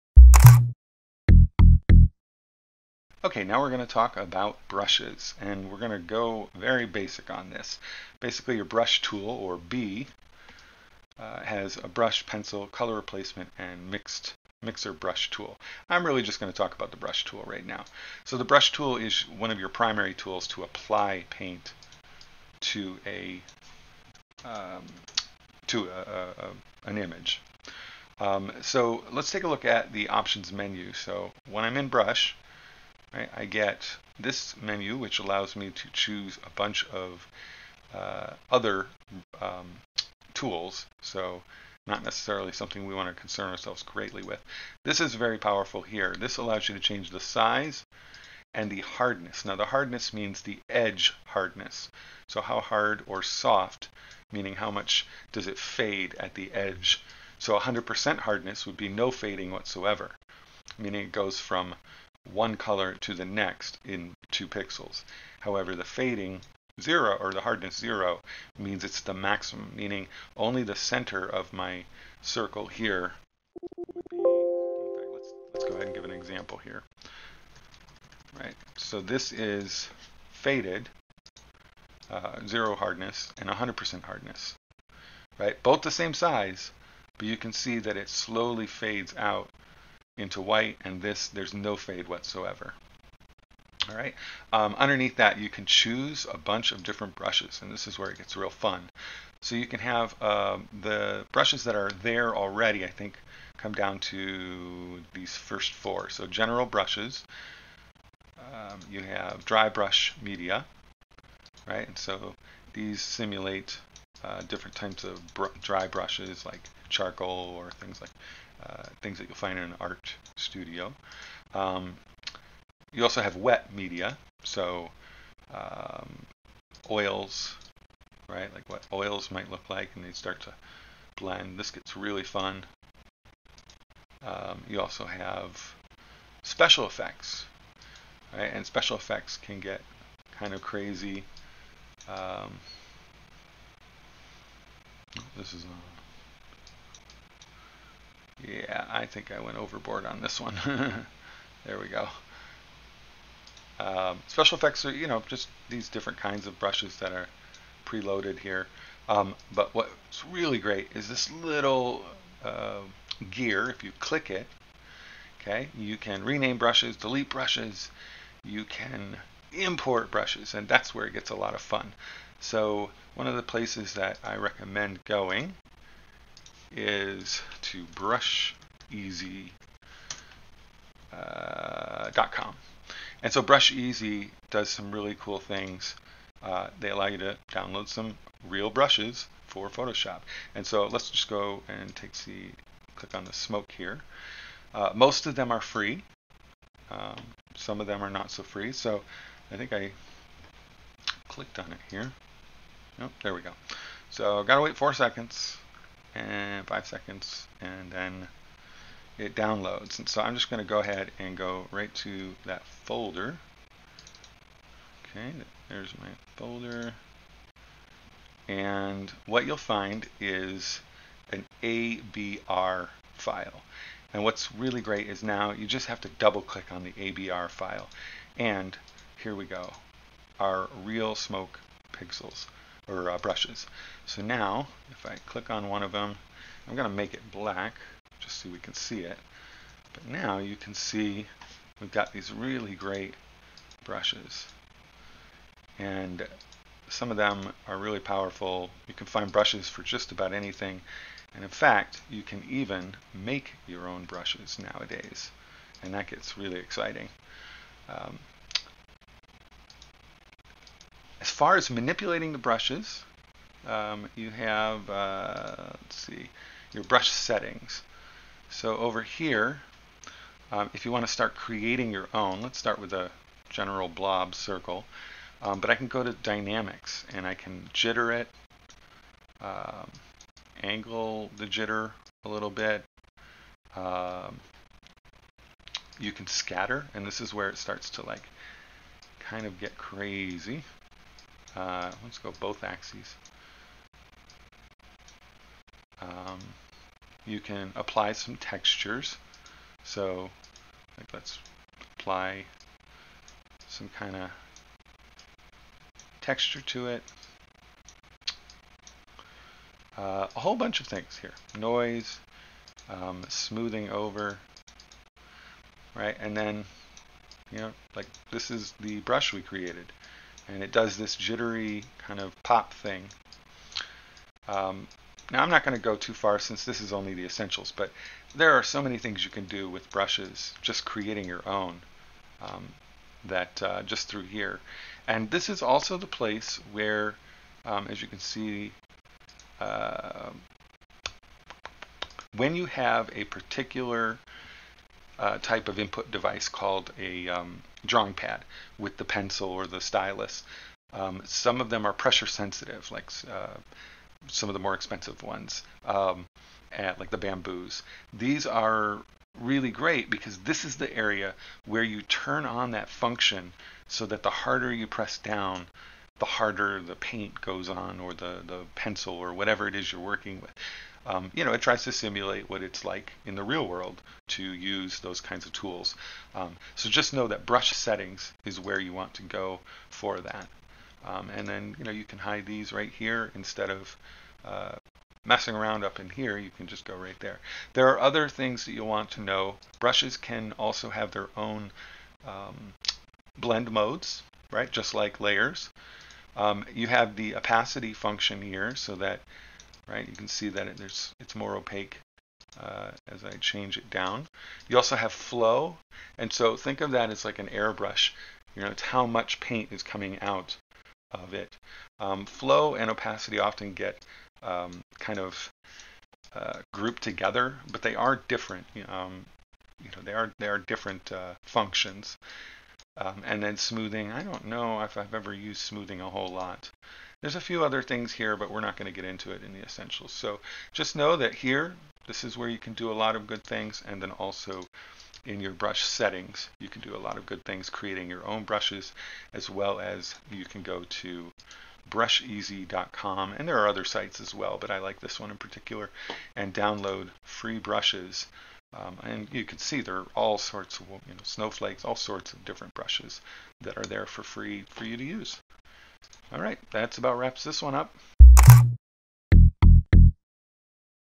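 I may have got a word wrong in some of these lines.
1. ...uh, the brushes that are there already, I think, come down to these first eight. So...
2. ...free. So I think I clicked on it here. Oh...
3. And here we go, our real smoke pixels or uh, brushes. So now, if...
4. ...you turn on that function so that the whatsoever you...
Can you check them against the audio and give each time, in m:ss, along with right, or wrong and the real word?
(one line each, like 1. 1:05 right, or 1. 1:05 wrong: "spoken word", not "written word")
1. 1:40 wrong: "four", not "eight"
2. 3:18 right
3. 3:48 right
4. 6:01 wrong: "harder", not "whatsoever".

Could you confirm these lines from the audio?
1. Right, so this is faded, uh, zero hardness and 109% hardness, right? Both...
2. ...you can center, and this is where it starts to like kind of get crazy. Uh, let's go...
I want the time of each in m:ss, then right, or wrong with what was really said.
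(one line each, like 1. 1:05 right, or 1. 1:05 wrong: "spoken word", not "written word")
1. 1:18 wrong: "100", not "109"
2. 4:45 wrong: "scatter", not "center".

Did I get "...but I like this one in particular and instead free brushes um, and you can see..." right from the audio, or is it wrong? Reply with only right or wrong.
wrong.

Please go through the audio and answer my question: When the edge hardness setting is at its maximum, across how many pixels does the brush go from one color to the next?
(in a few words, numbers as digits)
2.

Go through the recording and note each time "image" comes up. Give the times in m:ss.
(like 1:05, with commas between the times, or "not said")
0:26.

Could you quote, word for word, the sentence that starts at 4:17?
Um, as far as manipulating the brushes, um, you have, uh, let's see, your brush settings.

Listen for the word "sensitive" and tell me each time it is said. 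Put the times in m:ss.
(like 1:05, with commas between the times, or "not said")
5:52.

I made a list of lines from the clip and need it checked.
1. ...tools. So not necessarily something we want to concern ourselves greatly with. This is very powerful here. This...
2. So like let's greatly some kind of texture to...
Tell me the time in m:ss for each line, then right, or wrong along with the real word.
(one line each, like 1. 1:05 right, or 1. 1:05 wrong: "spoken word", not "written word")
1. 0:40 right
2. 4:59 wrong: "apply", not "greatly".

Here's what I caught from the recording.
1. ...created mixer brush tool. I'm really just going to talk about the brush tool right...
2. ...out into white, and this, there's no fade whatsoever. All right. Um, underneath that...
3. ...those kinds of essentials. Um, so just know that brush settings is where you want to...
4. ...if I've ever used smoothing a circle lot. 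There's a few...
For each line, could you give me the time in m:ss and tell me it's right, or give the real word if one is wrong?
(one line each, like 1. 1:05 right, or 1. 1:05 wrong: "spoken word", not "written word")
1. 0:13 wrong: "mixed", not "created"
2. 1:29 right
3. 6:14 wrong: "tools", not "essentials"
4. 7:04 wrong: "whole", not "circle".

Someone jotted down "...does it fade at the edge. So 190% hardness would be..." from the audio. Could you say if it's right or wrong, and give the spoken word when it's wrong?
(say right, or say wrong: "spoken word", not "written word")
wrong: "100", not "190".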